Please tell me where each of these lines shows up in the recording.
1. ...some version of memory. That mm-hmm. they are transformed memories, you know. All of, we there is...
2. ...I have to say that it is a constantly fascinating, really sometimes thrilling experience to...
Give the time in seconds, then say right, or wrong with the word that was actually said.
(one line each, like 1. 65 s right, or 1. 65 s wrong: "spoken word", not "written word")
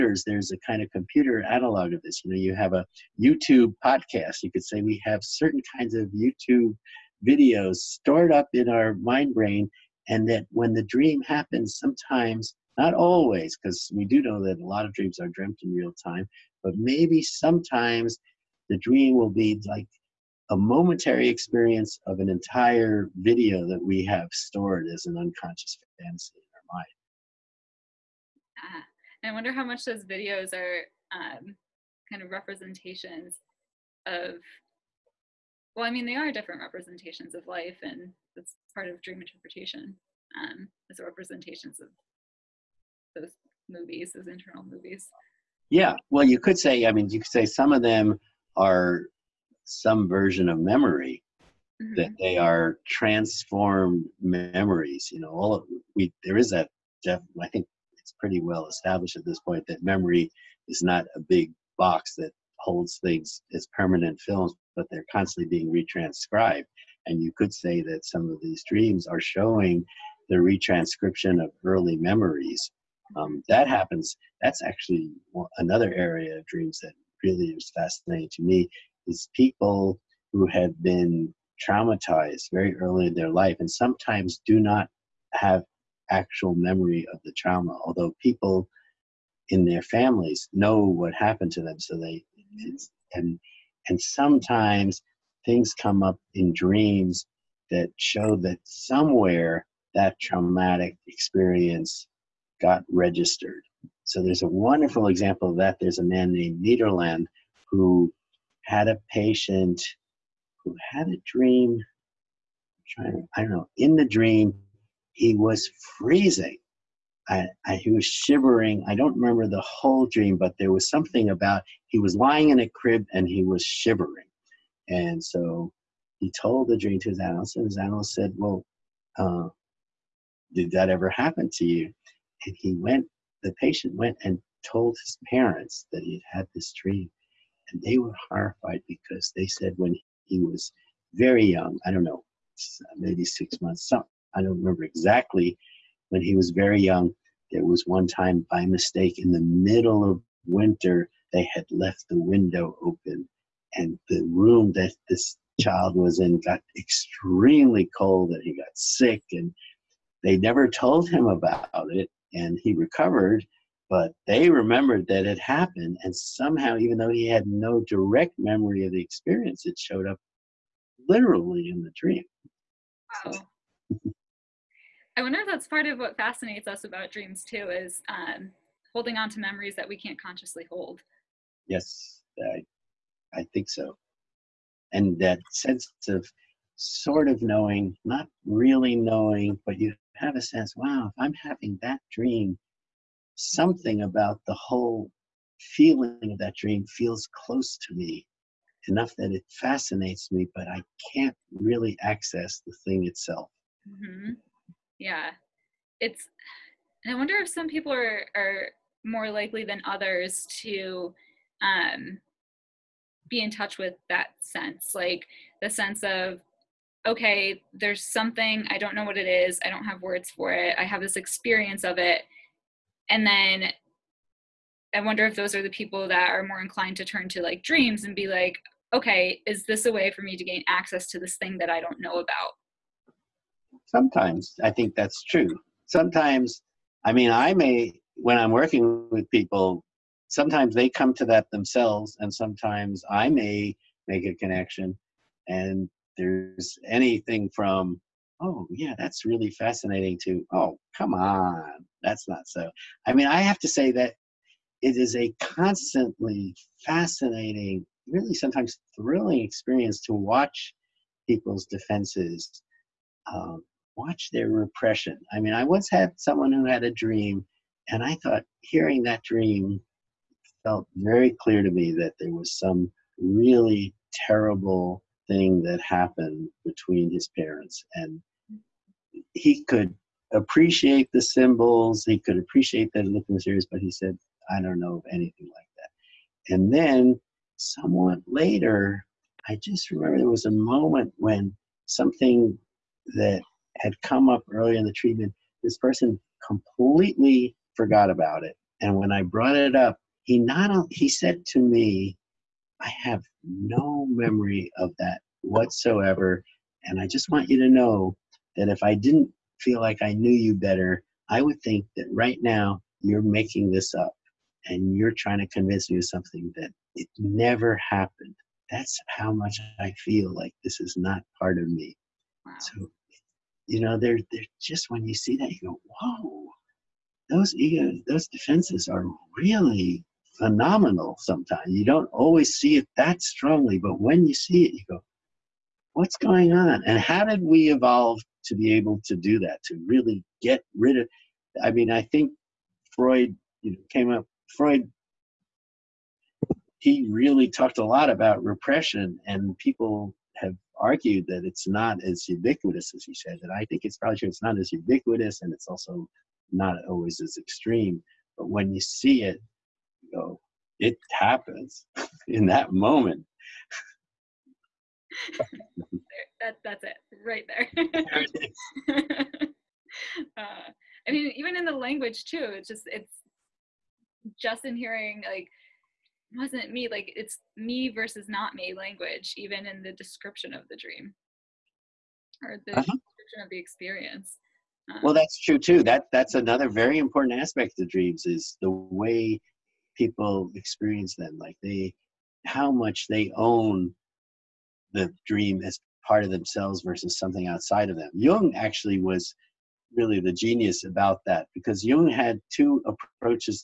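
1. 49 s right
2. 253 s right.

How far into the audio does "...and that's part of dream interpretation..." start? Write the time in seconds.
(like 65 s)
37 s.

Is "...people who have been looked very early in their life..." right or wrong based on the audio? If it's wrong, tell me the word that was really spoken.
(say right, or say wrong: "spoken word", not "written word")
wrong: "traumatized", not "looked".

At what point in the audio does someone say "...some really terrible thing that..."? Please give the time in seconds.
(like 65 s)
272 s.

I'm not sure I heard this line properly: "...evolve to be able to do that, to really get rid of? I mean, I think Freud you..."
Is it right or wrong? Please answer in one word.
right.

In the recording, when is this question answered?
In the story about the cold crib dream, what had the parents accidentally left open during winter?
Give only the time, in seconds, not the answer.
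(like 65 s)
152 s.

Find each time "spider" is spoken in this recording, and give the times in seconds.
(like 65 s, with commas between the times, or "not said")
not said.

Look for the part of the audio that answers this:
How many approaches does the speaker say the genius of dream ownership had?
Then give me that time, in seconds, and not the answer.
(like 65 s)
402 s.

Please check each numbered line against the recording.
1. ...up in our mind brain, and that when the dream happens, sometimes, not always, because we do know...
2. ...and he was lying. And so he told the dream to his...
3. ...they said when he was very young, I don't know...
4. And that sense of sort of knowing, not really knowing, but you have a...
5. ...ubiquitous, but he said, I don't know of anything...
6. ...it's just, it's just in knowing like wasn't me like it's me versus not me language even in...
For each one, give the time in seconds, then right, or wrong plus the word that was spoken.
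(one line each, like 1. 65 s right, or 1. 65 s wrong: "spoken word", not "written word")
1. 8 s right
2. 123 s wrong: "shivering", not "lying"
3. 139 s right
4. 184 s right
5. 283 s wrong: "mysterious", not "ubiquitous"
6. 372 s wrong: "hearing", not "knowing".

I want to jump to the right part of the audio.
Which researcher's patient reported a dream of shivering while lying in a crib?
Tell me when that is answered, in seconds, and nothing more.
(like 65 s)
106 s.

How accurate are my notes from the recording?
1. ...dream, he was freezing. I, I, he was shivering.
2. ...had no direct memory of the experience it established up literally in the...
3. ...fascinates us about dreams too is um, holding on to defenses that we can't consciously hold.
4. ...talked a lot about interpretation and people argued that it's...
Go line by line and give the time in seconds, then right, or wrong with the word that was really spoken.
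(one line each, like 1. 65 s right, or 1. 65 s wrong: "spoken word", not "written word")
1. 114 s right
2. 167 s wrong: "showed", not "established"
3. 176 s wrong: "memories", not "defenses"
4. 347 s wrong: "repression", not "interpretation".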